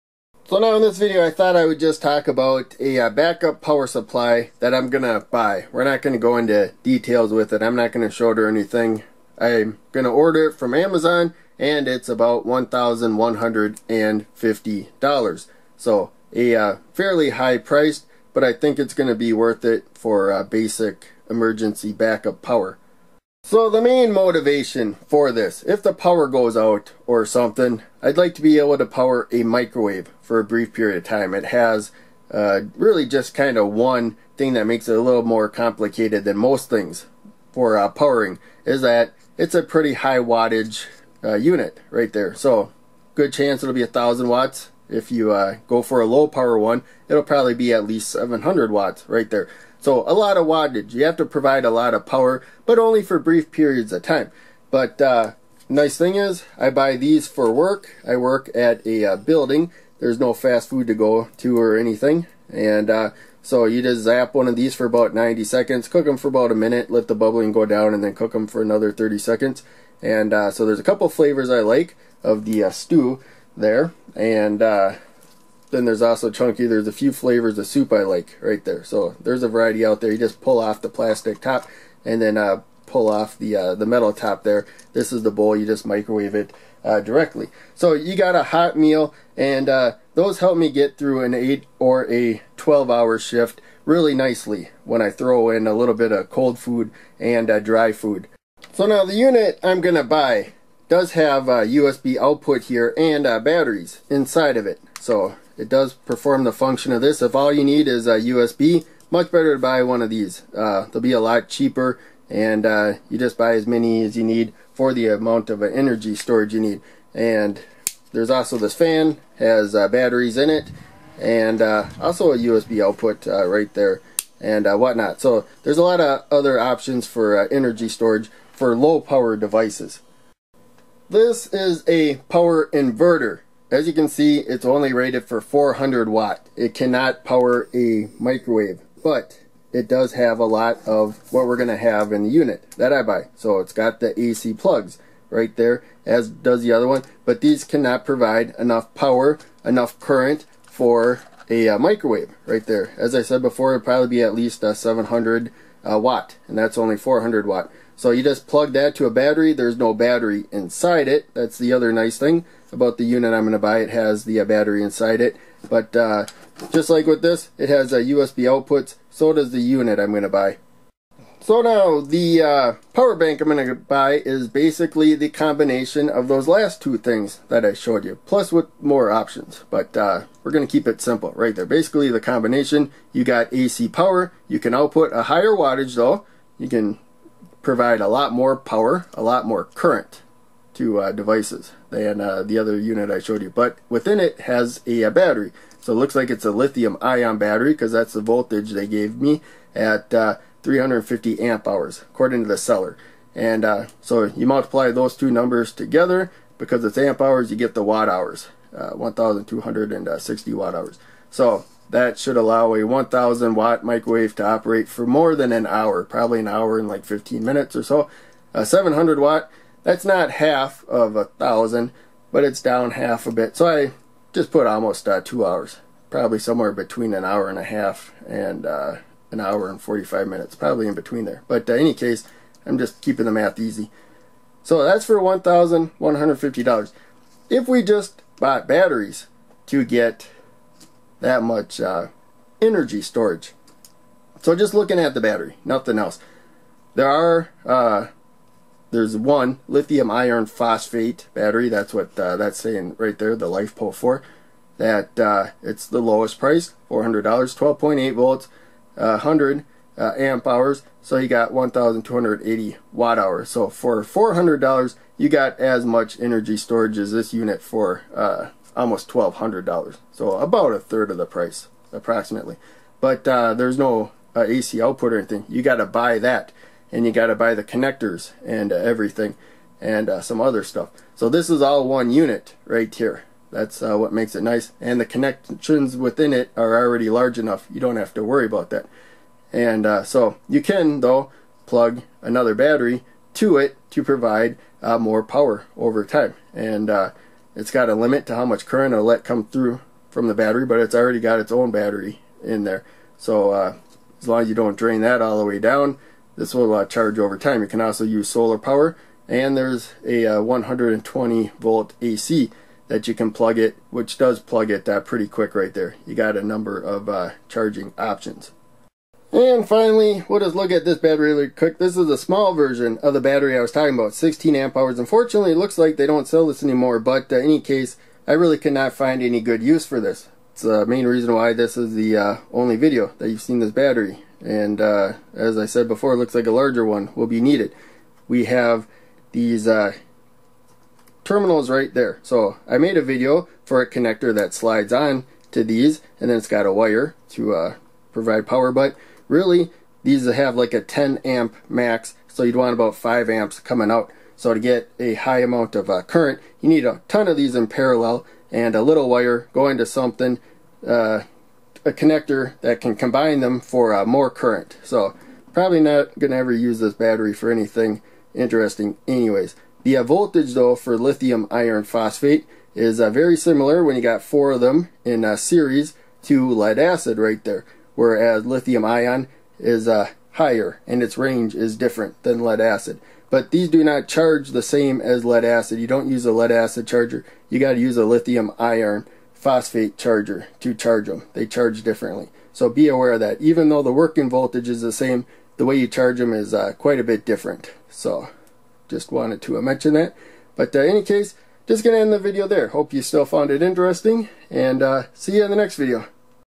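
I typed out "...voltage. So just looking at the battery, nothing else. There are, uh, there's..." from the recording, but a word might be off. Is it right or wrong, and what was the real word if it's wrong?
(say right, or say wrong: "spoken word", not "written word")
wrong: "storage", not "voltage".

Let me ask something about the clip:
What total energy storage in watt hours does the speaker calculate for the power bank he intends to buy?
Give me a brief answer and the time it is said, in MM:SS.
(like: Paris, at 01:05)
1260 watt hours, at 03:28.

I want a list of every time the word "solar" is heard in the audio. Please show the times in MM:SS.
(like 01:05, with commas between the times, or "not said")
05:08.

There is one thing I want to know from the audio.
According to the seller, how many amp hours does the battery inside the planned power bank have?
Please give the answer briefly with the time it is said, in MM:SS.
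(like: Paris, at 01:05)
350 amp hours, at 03:20.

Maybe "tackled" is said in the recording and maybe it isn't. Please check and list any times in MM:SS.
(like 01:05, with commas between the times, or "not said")
not said.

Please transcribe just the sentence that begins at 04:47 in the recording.
You don't have to worry about that.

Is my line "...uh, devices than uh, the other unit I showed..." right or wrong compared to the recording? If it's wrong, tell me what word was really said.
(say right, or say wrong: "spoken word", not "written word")
right.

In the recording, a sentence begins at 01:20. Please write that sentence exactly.
You just pull off the plastic top and then uh, pull off the uh, the metal top there.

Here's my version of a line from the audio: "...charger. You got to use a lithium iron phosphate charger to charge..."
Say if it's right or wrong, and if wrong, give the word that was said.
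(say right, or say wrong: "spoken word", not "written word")
right.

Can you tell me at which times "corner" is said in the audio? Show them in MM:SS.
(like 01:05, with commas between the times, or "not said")
not said.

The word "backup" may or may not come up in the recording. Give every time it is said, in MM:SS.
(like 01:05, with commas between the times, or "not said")
00:03, 00:21.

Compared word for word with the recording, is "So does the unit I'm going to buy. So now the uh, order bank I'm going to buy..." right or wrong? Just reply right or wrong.
wrong.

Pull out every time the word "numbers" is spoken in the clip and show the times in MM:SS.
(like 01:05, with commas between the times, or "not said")
03:25, 05:16.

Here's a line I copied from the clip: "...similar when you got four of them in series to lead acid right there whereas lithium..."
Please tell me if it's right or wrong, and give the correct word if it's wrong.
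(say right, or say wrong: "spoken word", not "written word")
right.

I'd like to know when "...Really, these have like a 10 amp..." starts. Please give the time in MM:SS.
05:49.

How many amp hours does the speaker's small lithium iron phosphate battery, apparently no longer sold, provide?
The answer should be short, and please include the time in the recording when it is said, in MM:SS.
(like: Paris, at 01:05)
16 amp hours, at 05:24.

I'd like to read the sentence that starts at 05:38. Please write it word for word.
We have these uh, terminals right there.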